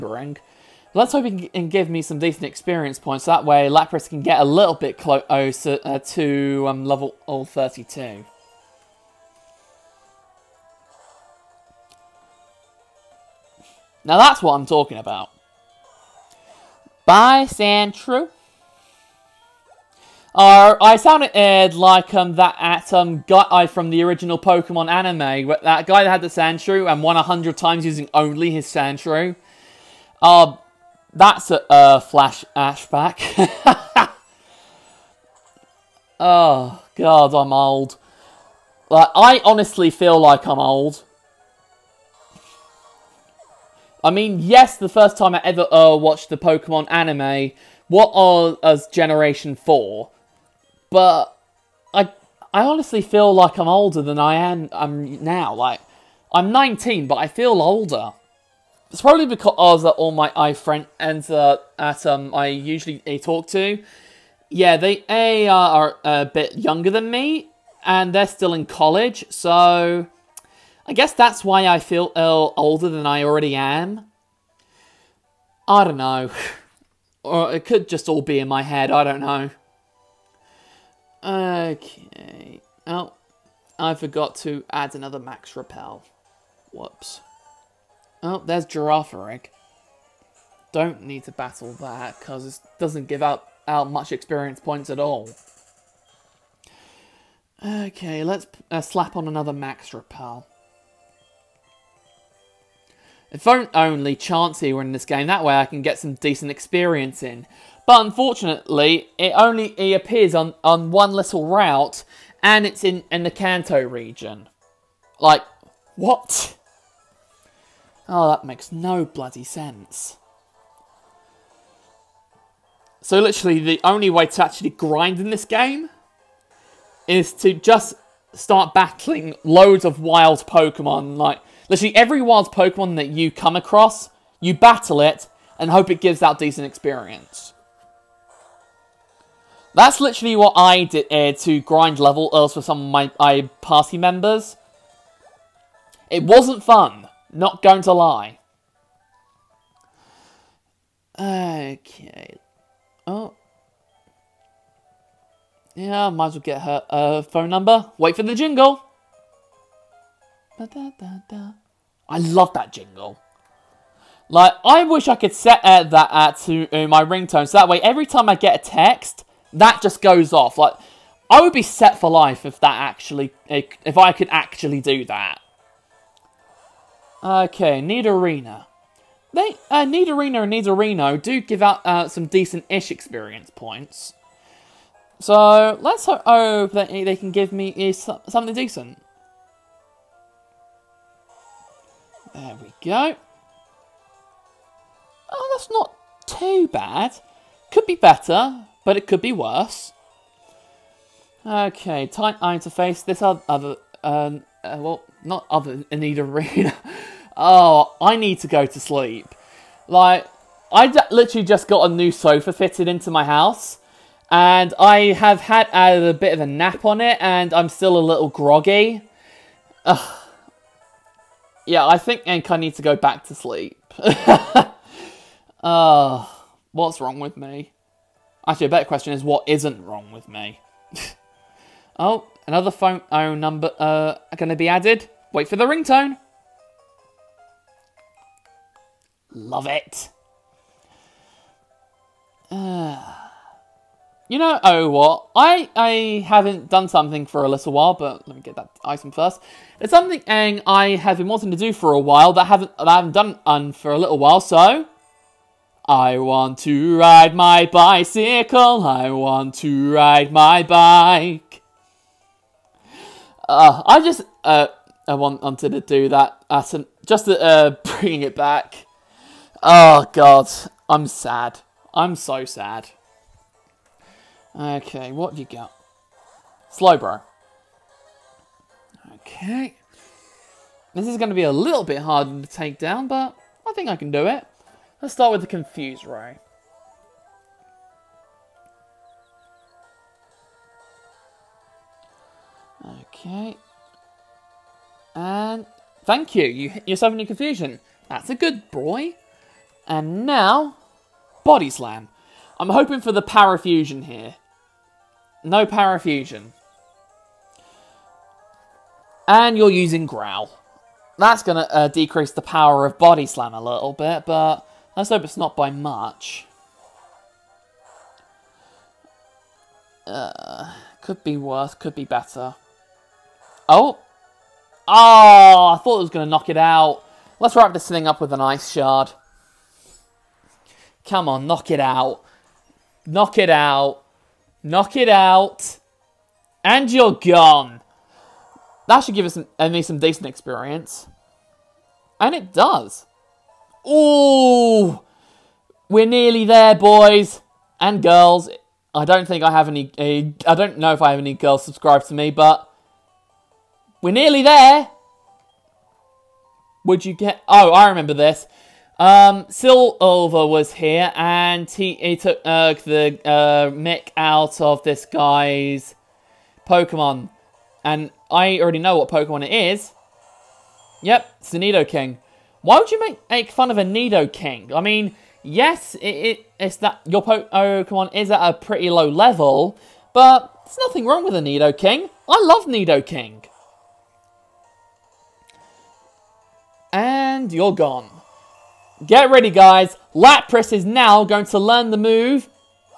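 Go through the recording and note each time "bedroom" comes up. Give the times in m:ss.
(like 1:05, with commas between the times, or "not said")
not said.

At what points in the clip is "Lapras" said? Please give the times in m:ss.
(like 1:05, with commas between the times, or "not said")
0:03, 6:30.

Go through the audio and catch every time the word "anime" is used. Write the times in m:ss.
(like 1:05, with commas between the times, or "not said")
0:24, 0:46.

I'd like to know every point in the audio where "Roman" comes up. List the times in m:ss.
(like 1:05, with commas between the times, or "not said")
not said.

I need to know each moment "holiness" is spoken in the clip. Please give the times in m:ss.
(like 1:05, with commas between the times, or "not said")
not said.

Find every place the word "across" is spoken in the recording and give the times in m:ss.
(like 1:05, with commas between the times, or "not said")
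2:13.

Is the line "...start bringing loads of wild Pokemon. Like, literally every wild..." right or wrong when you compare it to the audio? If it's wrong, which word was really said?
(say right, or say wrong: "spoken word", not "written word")
wrong: "battling", not "bringing".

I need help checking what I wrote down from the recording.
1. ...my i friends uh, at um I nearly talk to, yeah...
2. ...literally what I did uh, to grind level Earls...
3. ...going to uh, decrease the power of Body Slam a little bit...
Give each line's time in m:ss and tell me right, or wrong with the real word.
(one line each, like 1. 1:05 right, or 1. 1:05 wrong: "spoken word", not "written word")
1. 1:00 wrong: "usually", not "nearly"
2. 2:20 right
3. 5:11 right.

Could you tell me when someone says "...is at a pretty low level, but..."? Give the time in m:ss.
6:18.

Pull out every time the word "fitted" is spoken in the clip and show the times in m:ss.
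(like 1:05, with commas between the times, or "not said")
3:32.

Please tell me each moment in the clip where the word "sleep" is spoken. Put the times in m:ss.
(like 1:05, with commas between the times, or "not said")
3:28, 3:43.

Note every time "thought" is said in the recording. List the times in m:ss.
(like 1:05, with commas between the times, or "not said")
5:25.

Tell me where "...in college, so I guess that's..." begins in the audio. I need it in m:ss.
1:08.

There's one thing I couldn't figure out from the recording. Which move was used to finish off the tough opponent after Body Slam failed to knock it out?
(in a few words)
Ice Shard.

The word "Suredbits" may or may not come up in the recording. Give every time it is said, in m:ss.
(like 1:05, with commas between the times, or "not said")
not said.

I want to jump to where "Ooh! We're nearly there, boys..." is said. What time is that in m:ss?
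5:43.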